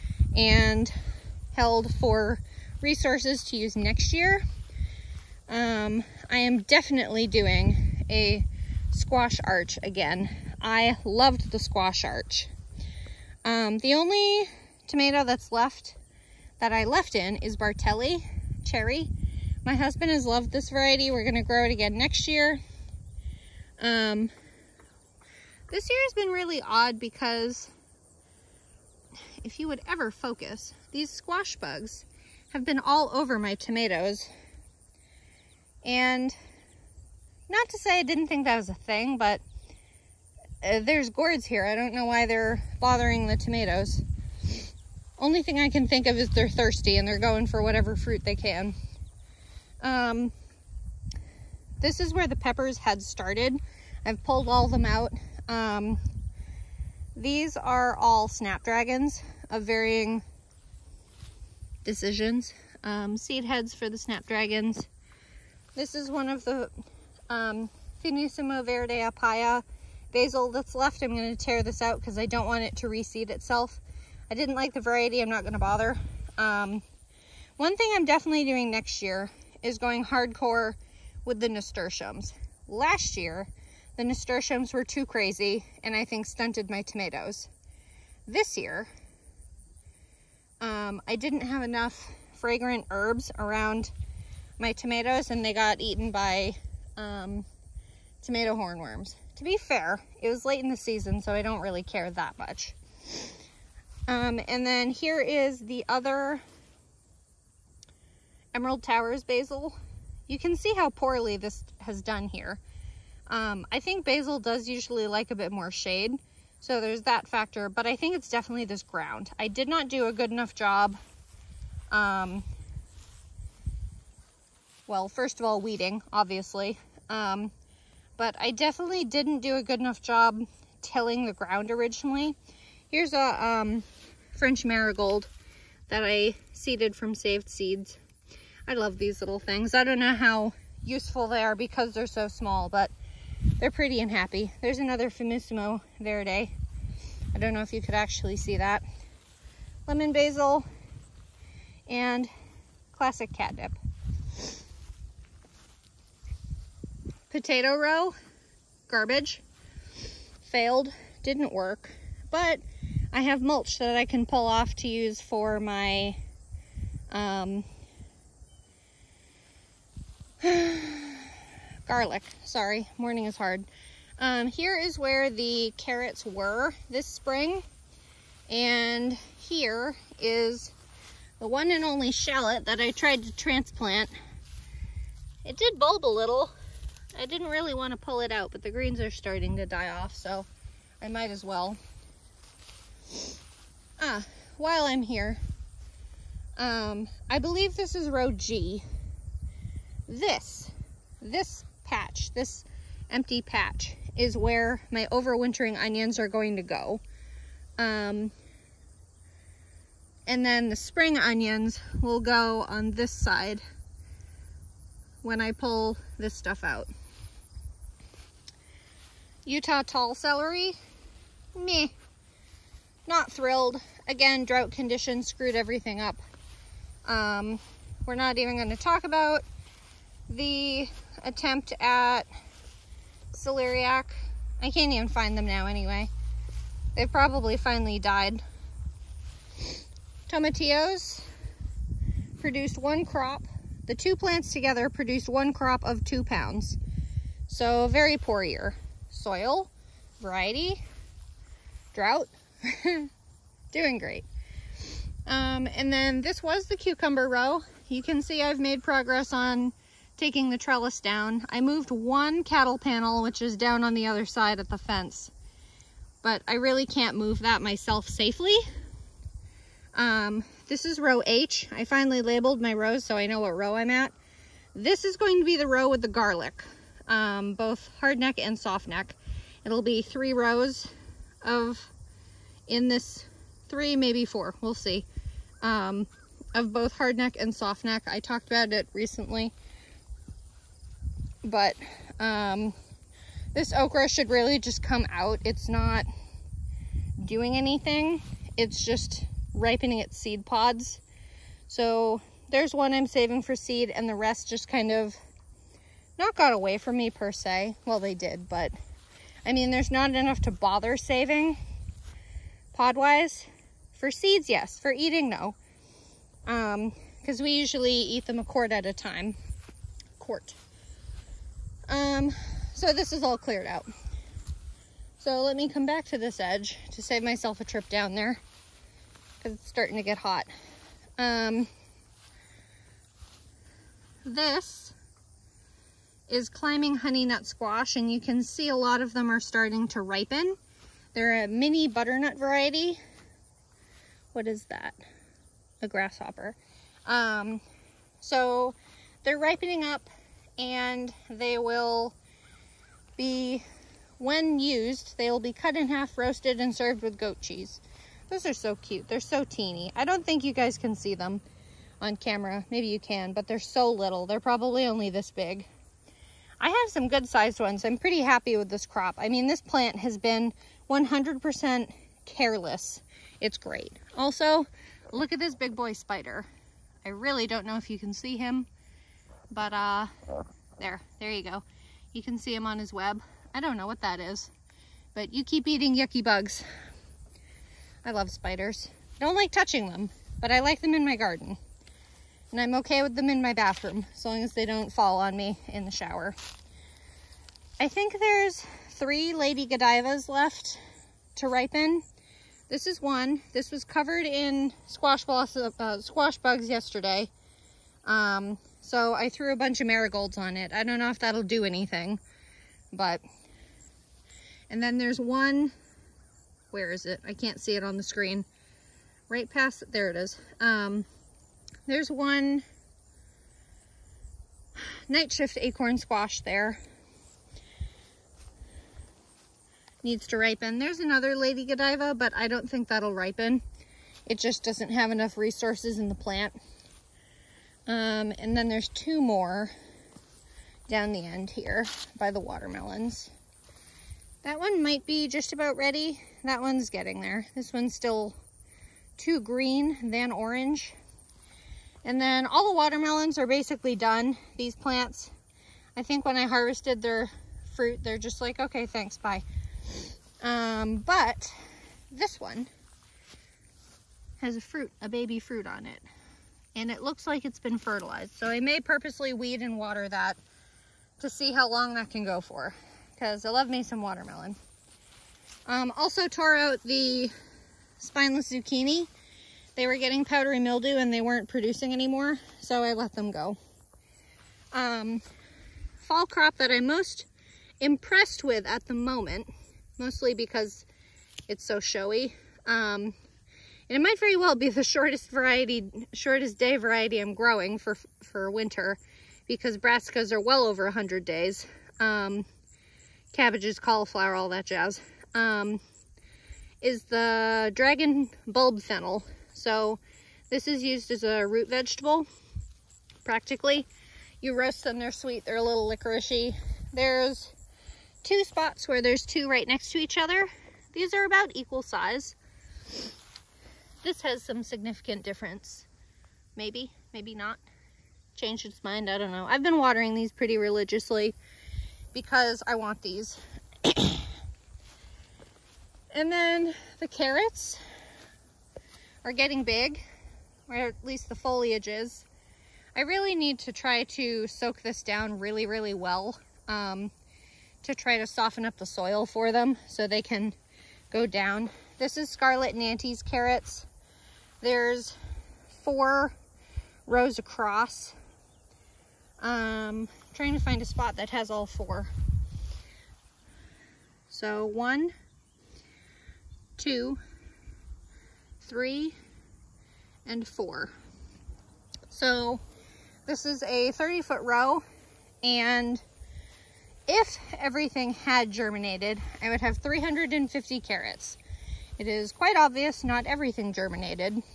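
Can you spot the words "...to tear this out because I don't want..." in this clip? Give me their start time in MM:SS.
01:11.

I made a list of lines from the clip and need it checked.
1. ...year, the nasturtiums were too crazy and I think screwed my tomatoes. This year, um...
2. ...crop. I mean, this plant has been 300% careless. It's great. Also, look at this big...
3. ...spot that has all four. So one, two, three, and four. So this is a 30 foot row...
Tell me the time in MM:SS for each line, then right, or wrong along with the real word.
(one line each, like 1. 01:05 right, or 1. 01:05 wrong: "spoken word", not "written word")
1. 01:23 wrong: "stunted", not "screwed"
2. 06:08 wrong: "100", not "300"
3. 09:20 right.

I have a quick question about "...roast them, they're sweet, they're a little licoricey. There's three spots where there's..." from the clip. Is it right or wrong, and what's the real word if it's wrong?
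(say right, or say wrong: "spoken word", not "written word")
wrong: "two", not "three".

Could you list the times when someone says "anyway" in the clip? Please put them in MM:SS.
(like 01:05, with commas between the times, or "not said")
03:55.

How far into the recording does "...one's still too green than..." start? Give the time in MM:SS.
07:27.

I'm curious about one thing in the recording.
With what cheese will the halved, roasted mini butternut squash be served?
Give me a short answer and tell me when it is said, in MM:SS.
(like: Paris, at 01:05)
Goat cheese, at 05:57.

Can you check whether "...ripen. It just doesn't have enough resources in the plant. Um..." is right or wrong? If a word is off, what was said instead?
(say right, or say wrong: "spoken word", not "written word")
right.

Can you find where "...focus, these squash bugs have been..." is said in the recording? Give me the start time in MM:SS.
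00:30.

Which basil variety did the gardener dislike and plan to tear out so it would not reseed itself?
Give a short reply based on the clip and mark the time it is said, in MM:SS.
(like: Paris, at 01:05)
Finissimo Verde a Palla, at 01:08.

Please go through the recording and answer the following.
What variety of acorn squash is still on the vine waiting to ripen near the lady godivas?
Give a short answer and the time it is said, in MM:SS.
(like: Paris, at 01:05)
Night shift, at 07:05.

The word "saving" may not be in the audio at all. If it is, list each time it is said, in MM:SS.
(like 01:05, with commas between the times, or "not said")
05:03, 05:10.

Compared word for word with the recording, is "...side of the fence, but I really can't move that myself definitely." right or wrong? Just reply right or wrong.
wrong.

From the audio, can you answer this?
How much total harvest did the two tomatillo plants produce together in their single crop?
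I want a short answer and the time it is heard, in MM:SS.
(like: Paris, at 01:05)
2 pounds, at 04:06.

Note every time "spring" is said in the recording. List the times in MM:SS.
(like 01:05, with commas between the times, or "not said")
02:57, 03:30.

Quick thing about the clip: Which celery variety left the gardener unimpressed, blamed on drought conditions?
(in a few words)
Utah tall.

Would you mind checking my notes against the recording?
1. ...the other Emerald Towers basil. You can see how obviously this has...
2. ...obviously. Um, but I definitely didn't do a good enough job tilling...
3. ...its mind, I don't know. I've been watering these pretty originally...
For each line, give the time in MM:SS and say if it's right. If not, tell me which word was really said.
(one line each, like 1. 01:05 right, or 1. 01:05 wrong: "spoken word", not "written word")
1. 01:45 wrong: "poorly", not "obviously"
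2. 02:06 right
3. 08:48 wrong: "religiously", not "originally".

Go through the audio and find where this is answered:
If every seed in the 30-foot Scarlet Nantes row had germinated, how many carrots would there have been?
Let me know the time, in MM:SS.
09:39.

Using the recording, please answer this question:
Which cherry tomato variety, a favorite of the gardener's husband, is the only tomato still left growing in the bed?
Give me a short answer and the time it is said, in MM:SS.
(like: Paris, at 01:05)
Bartelly cherry, at 00:17.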